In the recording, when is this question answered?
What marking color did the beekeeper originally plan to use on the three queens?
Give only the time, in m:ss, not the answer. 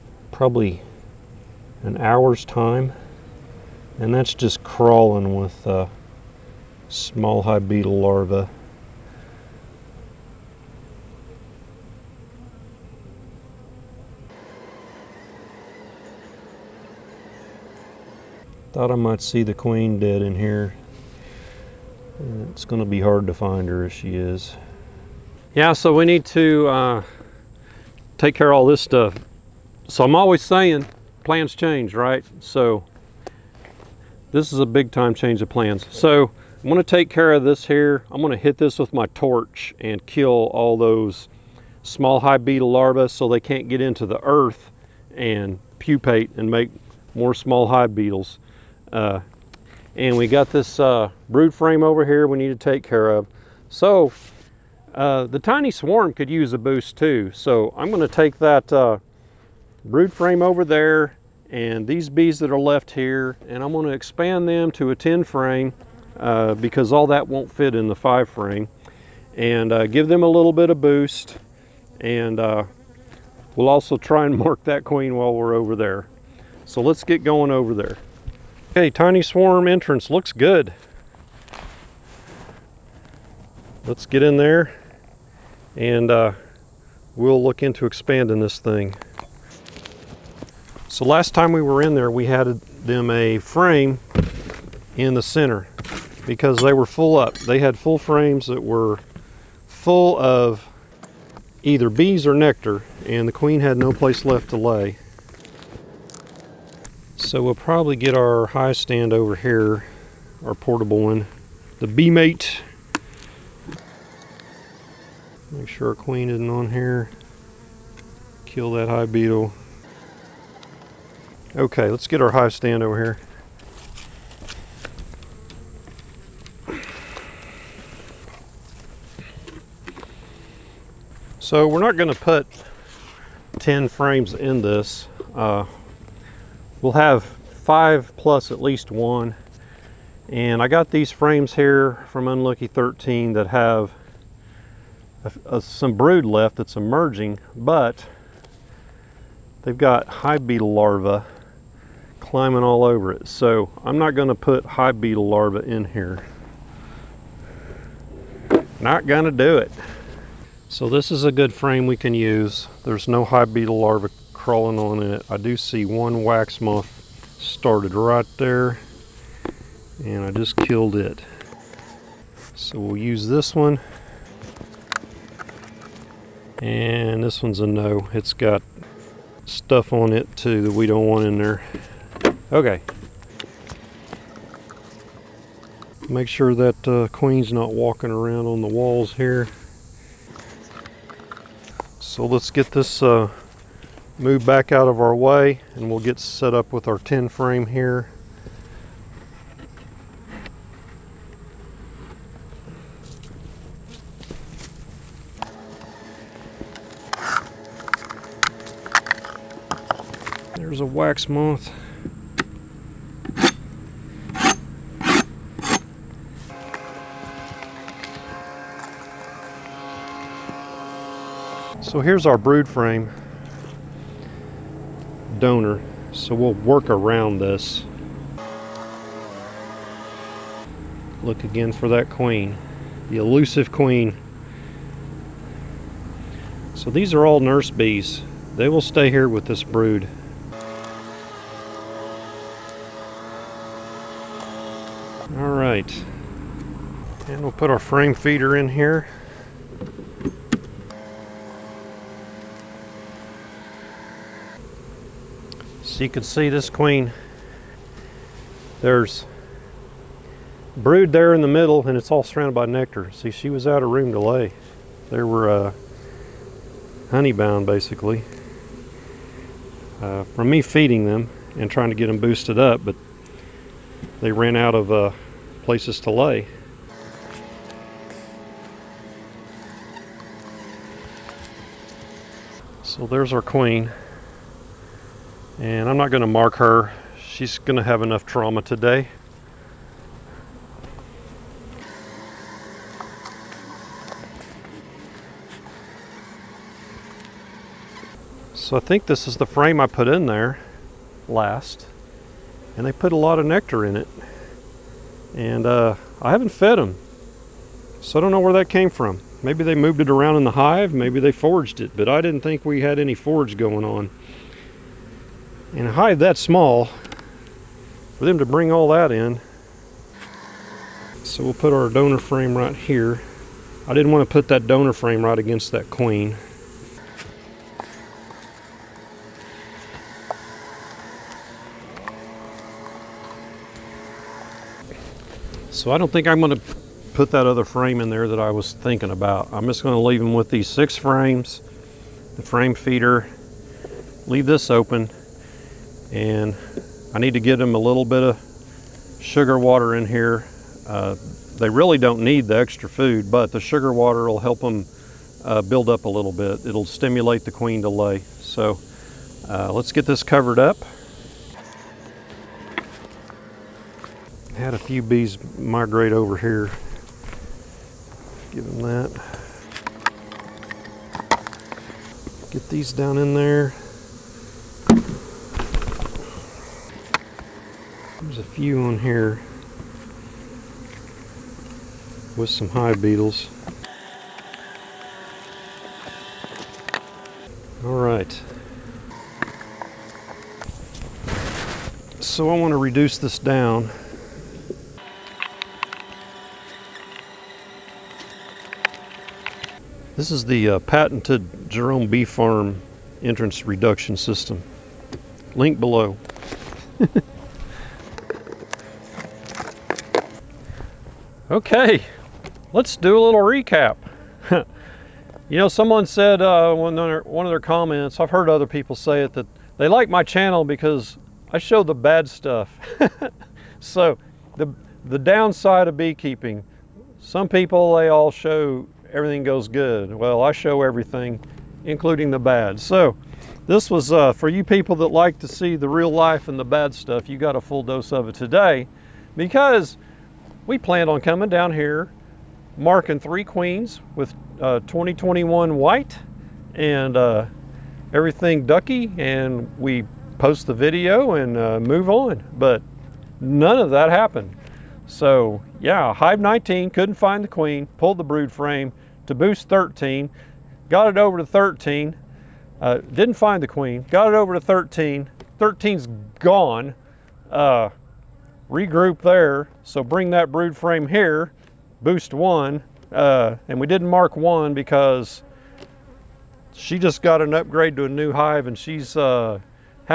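7:25.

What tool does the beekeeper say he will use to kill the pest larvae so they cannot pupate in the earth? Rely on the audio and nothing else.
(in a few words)
torch.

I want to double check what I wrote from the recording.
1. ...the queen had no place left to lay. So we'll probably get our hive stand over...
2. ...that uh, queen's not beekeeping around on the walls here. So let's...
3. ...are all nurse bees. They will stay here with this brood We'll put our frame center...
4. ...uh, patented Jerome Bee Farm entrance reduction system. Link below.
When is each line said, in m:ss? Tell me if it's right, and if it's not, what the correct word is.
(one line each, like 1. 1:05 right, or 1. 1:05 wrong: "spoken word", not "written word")
1. 1:43 right
2. 3:06 wrong: "walking", not "beekeeping"
3. 3:57 wrong: "feeder", not "center"
4. 6:40 right.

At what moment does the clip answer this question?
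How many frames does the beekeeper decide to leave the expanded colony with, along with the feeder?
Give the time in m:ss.
5:40.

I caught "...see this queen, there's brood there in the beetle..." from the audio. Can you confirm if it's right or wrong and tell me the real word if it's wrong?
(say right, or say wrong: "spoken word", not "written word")
wrong: "middle", not "beetle".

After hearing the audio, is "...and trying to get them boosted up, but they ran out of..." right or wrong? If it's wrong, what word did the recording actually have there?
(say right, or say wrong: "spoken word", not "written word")
right.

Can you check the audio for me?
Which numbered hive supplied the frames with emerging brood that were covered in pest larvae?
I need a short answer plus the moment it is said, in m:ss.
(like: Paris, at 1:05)
Unlucky 13, at 2:22.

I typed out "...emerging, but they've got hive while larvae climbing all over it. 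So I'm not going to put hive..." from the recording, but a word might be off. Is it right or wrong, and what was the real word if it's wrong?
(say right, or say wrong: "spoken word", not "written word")
wrong: "beetle", not "while".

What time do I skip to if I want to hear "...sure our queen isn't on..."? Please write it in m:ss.
1:55.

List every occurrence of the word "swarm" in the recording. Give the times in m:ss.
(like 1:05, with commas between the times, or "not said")
0:55, 1:19.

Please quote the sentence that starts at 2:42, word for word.
There's no hive beetle larvae crawling on it.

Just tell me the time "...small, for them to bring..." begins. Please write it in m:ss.
5:16.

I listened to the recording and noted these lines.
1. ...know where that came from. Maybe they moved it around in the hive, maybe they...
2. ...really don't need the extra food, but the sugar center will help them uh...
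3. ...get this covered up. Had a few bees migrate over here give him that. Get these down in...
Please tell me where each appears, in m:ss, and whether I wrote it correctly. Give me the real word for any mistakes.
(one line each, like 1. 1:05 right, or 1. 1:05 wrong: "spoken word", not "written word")
1. 5:08 right
2. 5:51 wrong: "water", not "center"
3. 5:59 right.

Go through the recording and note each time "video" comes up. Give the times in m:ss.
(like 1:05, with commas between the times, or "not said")
7:30.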